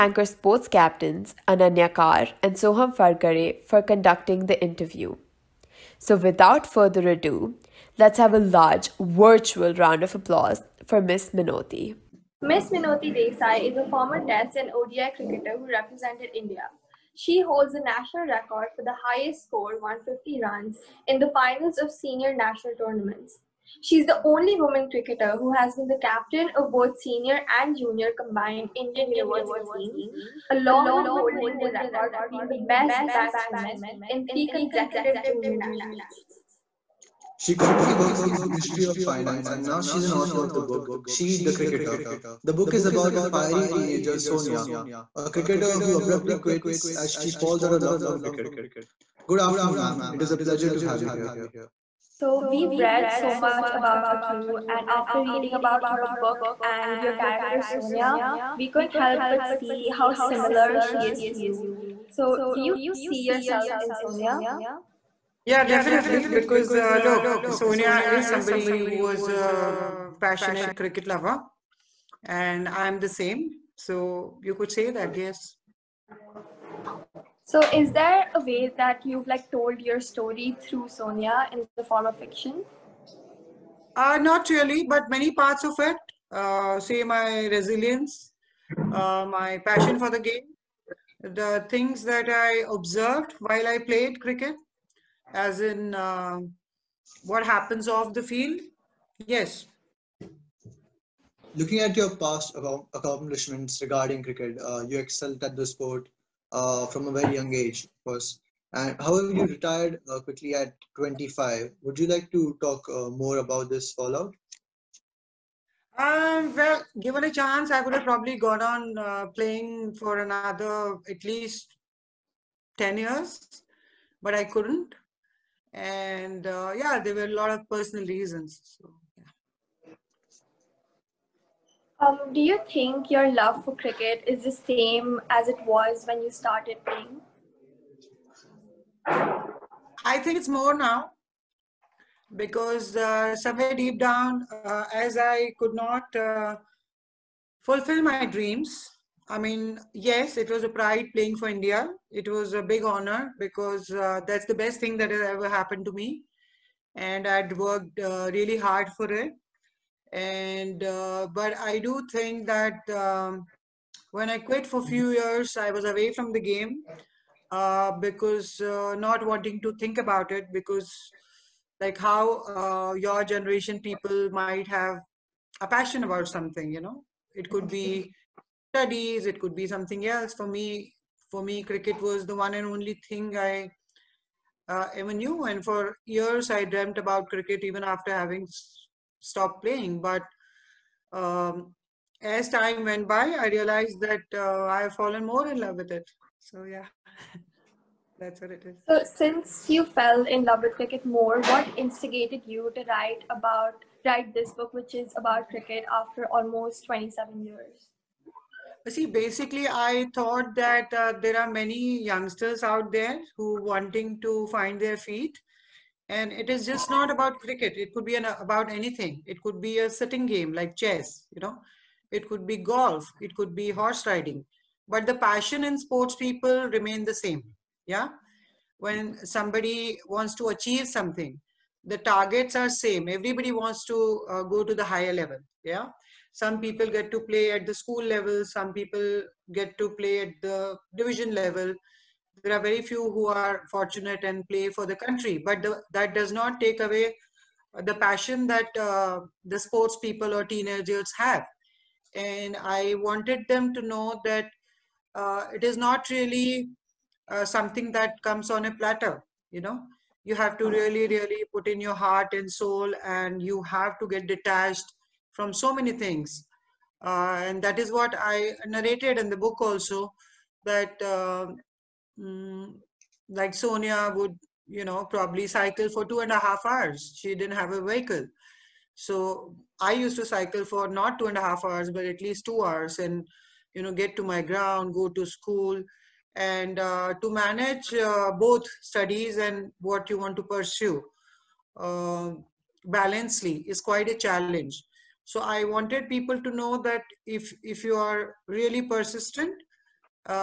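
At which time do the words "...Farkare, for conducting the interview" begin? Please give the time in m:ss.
0:02.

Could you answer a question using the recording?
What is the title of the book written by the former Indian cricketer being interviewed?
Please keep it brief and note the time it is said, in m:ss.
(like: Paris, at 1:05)
She the Cricketer, at 0:41.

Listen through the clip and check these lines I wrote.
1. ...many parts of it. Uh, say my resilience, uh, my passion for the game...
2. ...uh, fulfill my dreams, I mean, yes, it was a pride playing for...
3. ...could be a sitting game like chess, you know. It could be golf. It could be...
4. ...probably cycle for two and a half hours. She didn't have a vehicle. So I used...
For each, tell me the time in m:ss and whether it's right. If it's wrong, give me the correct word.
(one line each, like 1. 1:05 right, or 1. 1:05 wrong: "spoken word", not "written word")
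1. 1:25 right
2. 2:26 right
3. 3:39 right
4. 4:35 right.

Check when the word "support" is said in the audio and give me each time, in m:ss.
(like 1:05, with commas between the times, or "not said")
not said.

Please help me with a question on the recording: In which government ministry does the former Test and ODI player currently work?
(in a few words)
Ministry of Finance.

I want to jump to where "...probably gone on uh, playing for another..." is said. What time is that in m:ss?
1:58.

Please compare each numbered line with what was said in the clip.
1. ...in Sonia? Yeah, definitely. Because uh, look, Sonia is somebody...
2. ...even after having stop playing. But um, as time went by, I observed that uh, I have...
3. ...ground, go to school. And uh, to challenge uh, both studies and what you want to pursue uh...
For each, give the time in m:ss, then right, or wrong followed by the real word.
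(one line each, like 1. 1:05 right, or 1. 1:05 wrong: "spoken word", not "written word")
1. 1:03 right
2. 3:07 wrong: "realized", not "observed"
3. 4:44 wrong: "manage", not "challenge".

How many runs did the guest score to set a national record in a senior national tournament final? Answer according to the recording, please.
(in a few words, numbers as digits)
150.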